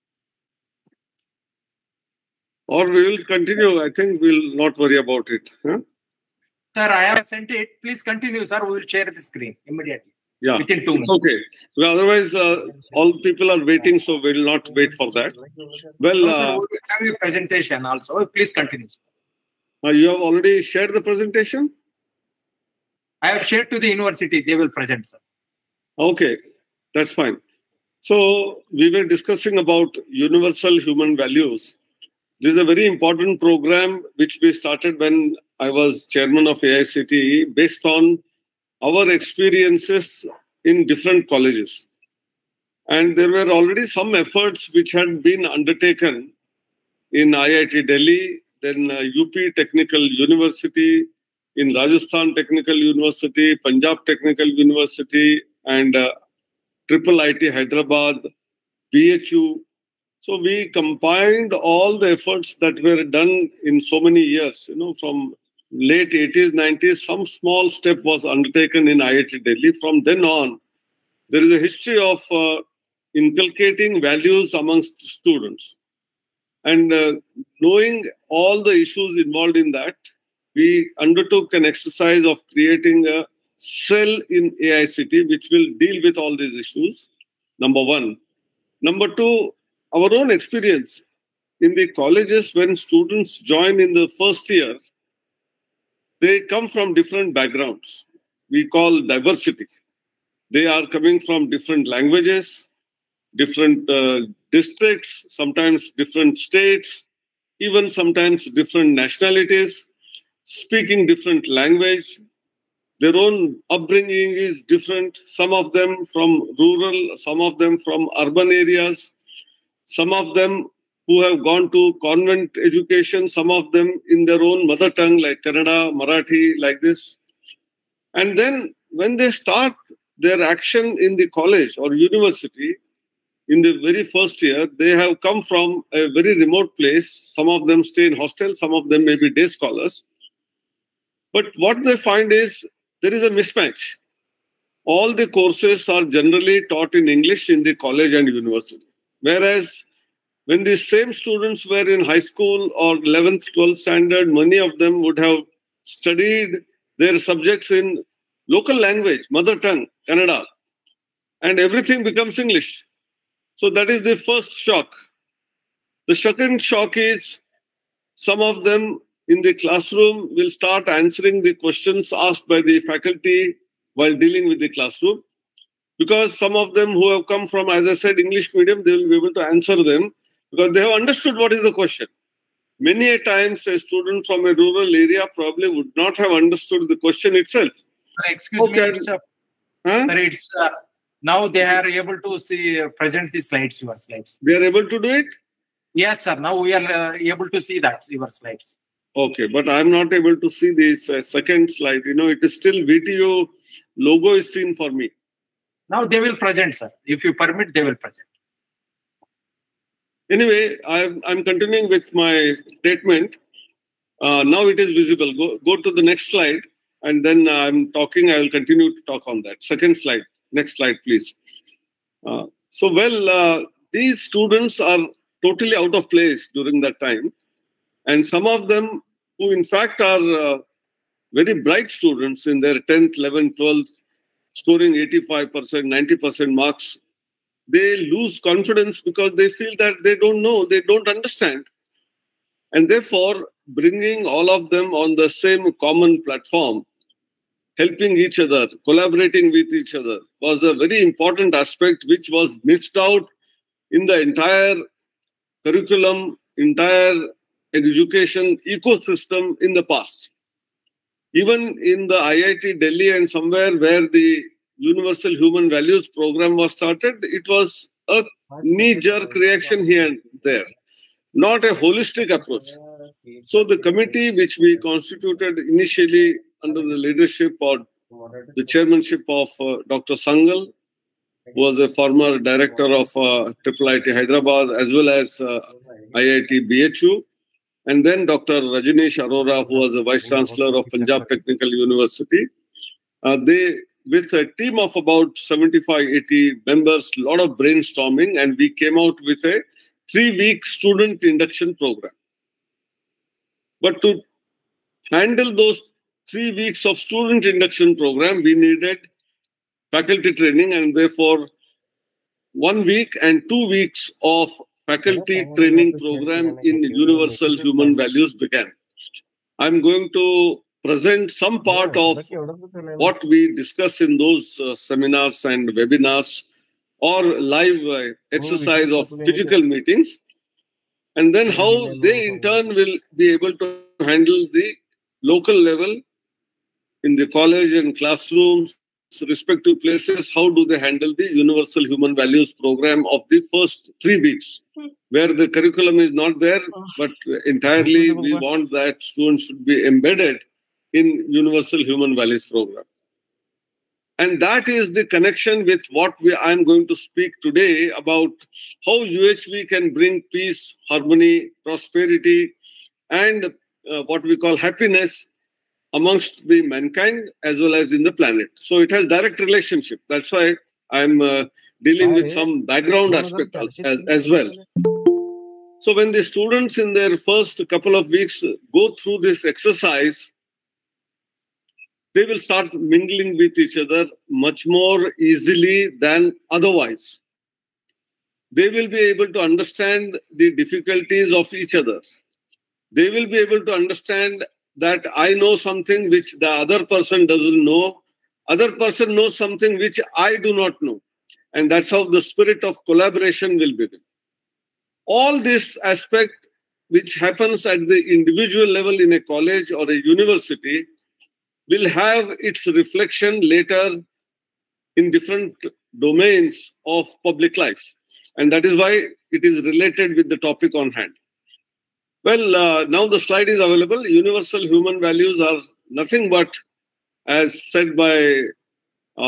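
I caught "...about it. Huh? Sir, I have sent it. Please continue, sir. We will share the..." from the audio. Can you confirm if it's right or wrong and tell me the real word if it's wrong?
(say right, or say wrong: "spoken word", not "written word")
right.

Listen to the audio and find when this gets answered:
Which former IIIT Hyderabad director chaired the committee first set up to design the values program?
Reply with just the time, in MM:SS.
04:39.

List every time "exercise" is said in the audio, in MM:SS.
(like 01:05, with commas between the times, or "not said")
01:21, 05:28, 06:19.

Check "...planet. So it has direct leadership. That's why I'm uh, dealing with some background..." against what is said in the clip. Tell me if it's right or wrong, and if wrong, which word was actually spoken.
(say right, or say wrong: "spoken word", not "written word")
wrong: "relationship", not "leadership".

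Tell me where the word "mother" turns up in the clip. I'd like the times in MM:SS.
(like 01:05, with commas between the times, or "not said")
02:04, 02:39.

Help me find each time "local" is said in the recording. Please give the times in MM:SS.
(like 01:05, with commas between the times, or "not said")
02:38, 05:35.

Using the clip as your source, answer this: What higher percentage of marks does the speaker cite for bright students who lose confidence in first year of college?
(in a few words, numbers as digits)
90%.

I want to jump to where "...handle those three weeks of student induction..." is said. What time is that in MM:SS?
05:05.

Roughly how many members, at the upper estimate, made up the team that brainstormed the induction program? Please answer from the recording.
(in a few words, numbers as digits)
80.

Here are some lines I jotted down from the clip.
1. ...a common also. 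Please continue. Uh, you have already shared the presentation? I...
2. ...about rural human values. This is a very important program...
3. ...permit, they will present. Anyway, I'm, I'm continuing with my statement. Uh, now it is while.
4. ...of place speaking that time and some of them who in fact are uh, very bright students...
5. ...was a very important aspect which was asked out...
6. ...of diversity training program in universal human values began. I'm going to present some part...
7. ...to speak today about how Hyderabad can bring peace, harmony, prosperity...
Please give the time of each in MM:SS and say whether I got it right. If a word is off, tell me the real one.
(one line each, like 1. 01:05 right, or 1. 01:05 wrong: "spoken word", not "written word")
1. 00:17 wrong: "presentation", not "common"
2. 00:29 wrong: "universal", not "rural"
3. 03:27 wrong: "visible", not "while"
4. 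03:45 wrong: "during", not "speaking"
5. 04:10 wrong: "missed", not "asked"
6. 05:14 wrong: "faculty", not "diversity"
7. 05:56 wrong: "UHV", not "Hyderabad".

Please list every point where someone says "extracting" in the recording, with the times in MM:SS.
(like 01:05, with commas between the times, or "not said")
not said.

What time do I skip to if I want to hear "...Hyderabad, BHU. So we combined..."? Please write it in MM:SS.
00:57.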